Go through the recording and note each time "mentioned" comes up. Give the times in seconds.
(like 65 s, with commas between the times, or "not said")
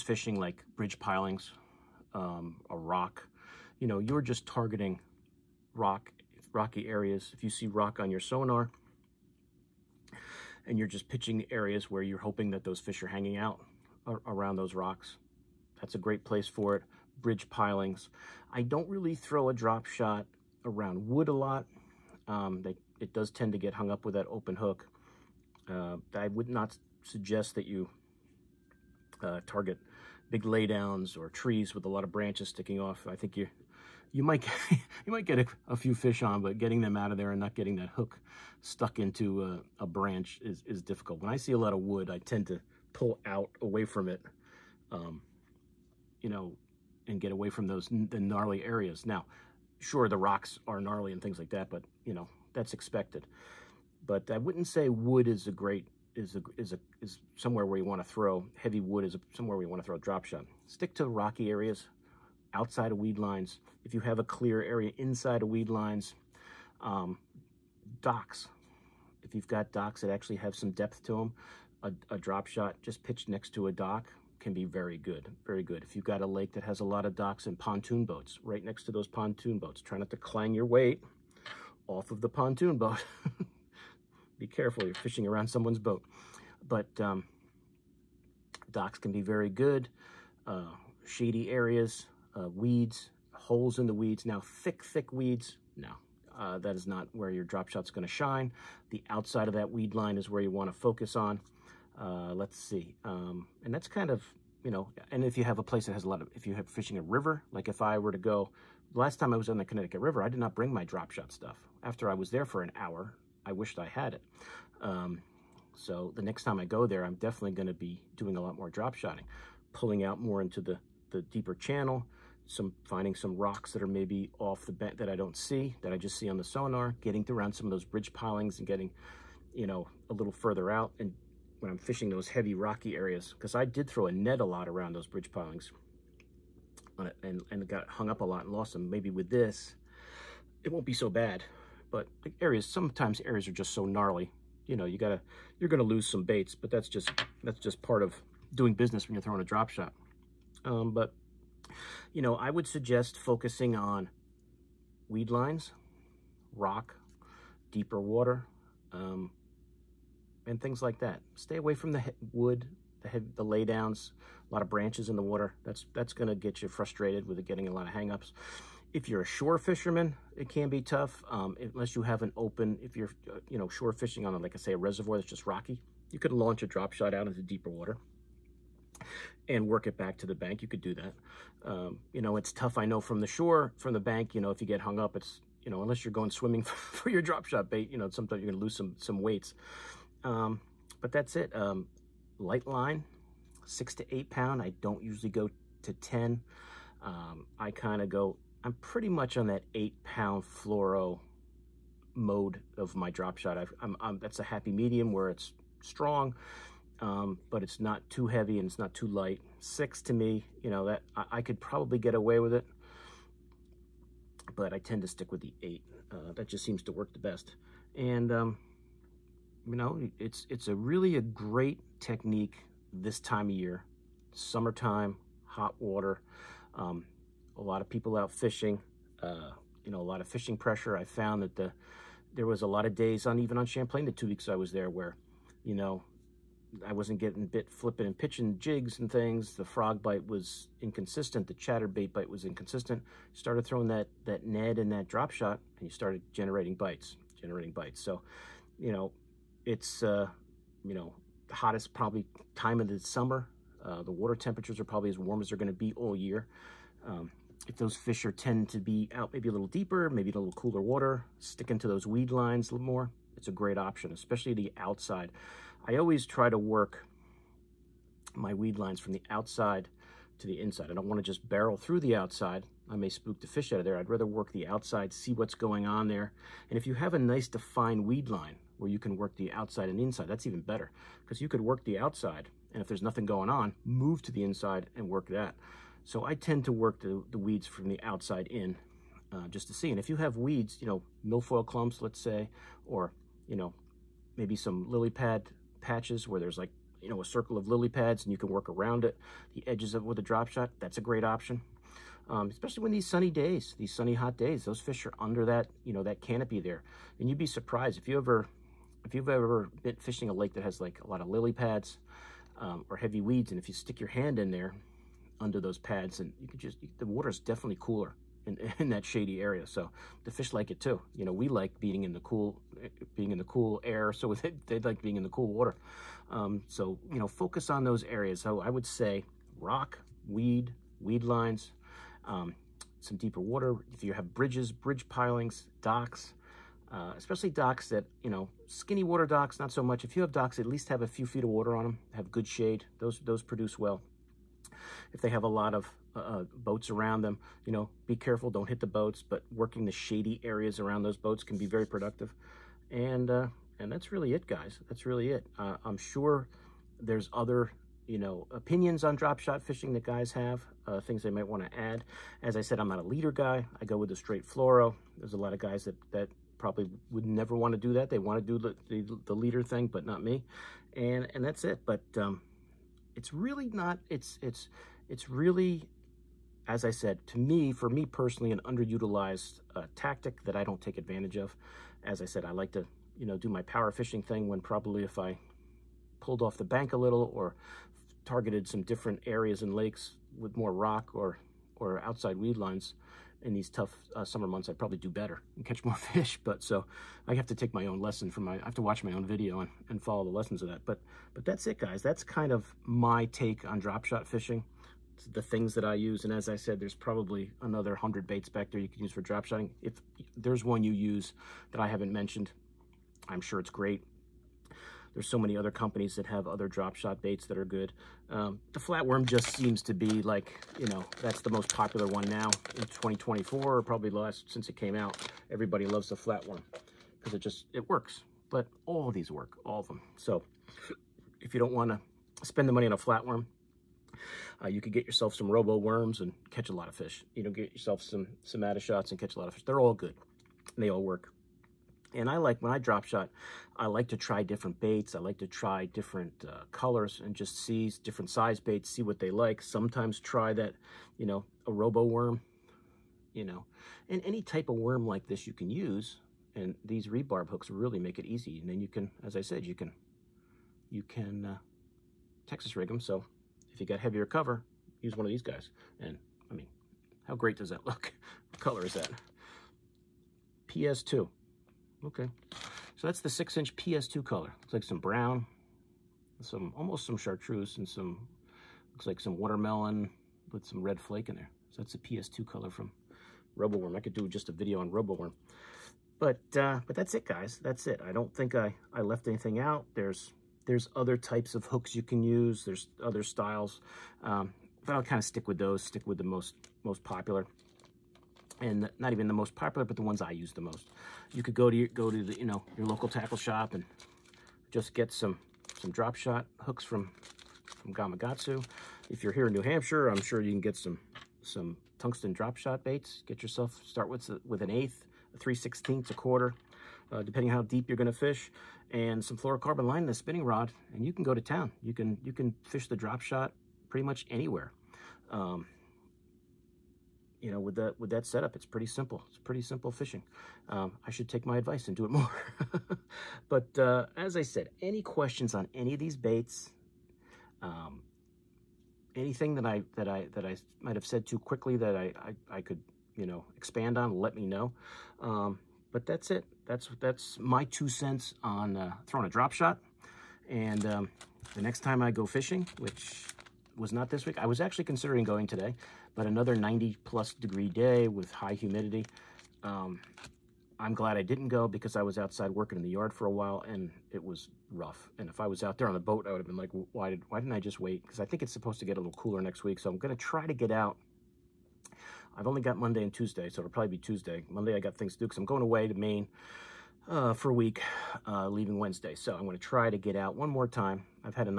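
412 s.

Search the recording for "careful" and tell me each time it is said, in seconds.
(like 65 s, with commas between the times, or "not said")
84 s, 348 s.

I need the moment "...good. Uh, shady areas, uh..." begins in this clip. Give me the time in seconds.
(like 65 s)
89 s.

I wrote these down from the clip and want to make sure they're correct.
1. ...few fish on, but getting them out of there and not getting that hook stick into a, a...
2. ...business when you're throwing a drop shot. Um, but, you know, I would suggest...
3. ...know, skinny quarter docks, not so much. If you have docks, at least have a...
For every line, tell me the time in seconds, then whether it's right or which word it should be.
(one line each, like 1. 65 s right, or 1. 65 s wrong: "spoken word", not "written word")
1. 35 s wrong: "stuck", not "stick"
2. 148 s right
3. 338 s wrong: "water", not "quarter".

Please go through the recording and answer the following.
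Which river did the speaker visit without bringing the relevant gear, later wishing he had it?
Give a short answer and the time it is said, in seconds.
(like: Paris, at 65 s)
Connecticut River, at 109 s.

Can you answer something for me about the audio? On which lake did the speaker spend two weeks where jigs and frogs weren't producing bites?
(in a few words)
Champlain.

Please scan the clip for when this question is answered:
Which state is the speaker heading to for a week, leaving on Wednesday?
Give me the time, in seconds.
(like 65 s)
575 s.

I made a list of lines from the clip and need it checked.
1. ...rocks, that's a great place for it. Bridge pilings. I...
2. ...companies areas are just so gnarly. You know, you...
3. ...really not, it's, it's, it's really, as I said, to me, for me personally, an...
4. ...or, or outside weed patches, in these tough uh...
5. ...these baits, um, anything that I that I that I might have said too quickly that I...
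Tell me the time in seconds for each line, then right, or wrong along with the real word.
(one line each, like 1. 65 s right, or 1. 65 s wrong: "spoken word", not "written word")
1. 14 s right
2. 142 s wrong: "sometimes", not "companies"
3. 373 s right
4. 391 s wrong: "lines", not "patches"
5. 535 s right.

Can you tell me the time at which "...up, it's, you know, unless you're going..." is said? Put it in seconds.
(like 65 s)
184 s.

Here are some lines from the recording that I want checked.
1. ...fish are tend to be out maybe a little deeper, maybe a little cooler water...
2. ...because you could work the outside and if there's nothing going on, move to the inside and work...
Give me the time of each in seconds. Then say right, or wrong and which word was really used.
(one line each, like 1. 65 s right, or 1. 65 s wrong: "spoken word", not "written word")
1. 257 s right
2. 281 s right.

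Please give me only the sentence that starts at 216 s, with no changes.
Uh, that just seems to work the best.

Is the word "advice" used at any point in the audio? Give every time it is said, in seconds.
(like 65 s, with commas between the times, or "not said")
531 s.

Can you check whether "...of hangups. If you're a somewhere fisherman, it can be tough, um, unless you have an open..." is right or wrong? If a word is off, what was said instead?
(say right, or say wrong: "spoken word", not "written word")
wrong: "shore", not "somewhere".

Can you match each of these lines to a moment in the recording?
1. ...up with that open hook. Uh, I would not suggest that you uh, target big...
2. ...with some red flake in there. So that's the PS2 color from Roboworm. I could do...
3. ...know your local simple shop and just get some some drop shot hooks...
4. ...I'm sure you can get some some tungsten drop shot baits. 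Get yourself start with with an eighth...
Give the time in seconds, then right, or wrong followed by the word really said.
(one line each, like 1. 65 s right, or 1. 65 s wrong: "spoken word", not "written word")
1. 23 s right
2. 480 s right
3. 502 s wrong: "tackle", not "simple"
4. 510 s right.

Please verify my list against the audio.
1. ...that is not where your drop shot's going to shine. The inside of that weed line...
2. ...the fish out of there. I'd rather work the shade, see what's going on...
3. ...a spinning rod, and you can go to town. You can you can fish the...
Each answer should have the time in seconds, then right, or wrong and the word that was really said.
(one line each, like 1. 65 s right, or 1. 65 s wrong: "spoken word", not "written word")
1. 96 s wrong: "outside", not "inside"
2. 273 s wrong: "outside", not "shade"
3. 520 s right.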